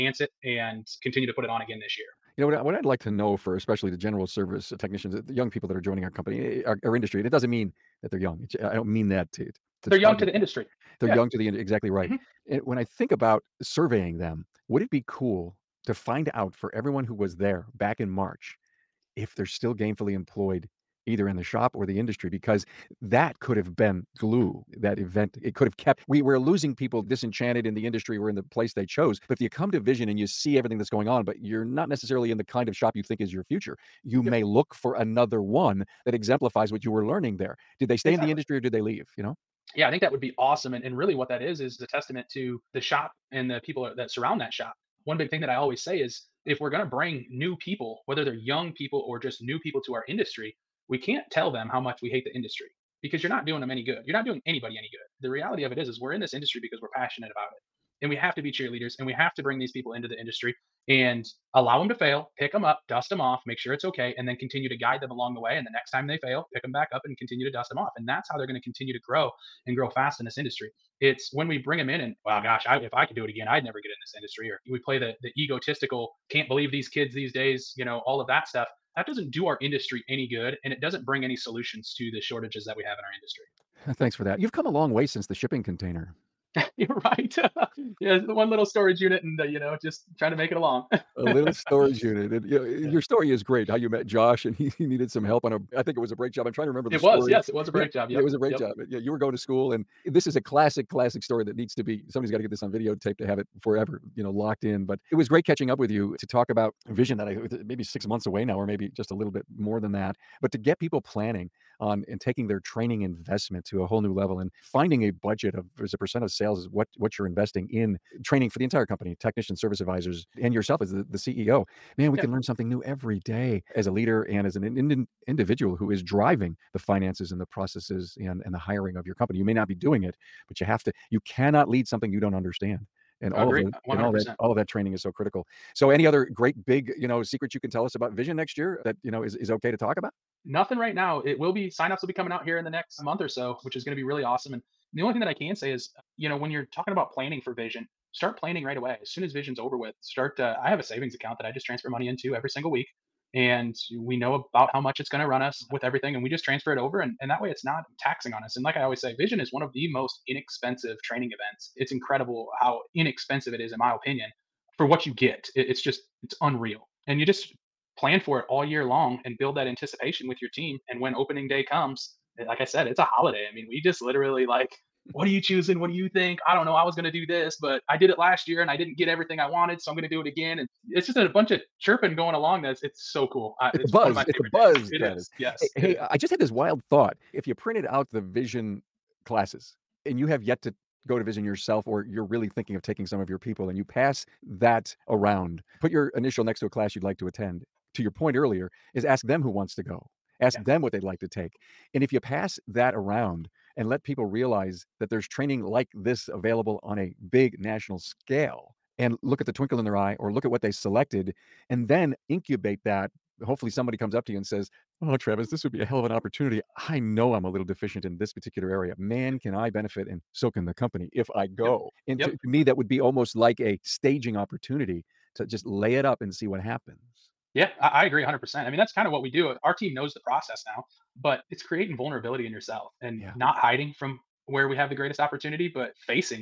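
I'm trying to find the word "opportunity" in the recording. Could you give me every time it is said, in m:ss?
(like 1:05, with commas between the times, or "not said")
3:36, 3:44, 3:55.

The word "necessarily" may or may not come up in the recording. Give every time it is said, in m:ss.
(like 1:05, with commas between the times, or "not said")
0:31.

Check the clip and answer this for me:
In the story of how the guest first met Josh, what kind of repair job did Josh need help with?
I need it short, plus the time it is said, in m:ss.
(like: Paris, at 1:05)
Brake job, at 1:36.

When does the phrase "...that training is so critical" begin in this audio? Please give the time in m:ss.
2:14.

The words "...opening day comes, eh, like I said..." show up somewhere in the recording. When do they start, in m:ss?
2:51.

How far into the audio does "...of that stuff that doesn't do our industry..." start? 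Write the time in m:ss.
1:18.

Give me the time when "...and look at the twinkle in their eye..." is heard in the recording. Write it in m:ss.
3:28.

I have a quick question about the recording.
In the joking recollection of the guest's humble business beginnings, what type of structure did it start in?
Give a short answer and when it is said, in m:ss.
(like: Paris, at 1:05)
Shipping container, at 1:25.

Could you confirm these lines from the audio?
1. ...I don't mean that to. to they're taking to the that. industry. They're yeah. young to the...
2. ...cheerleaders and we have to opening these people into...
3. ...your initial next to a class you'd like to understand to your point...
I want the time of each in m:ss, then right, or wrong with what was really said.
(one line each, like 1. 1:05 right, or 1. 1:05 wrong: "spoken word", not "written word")
1. 0:08 wrong: "young", not "taking"
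2. 0:58 wrong: "bring", not "opening"
3. 3:15 wrong: "attend", not "understand".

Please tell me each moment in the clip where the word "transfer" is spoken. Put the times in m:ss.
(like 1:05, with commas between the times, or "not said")
2:31, 2:36.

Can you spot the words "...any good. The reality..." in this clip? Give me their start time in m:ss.
0:54.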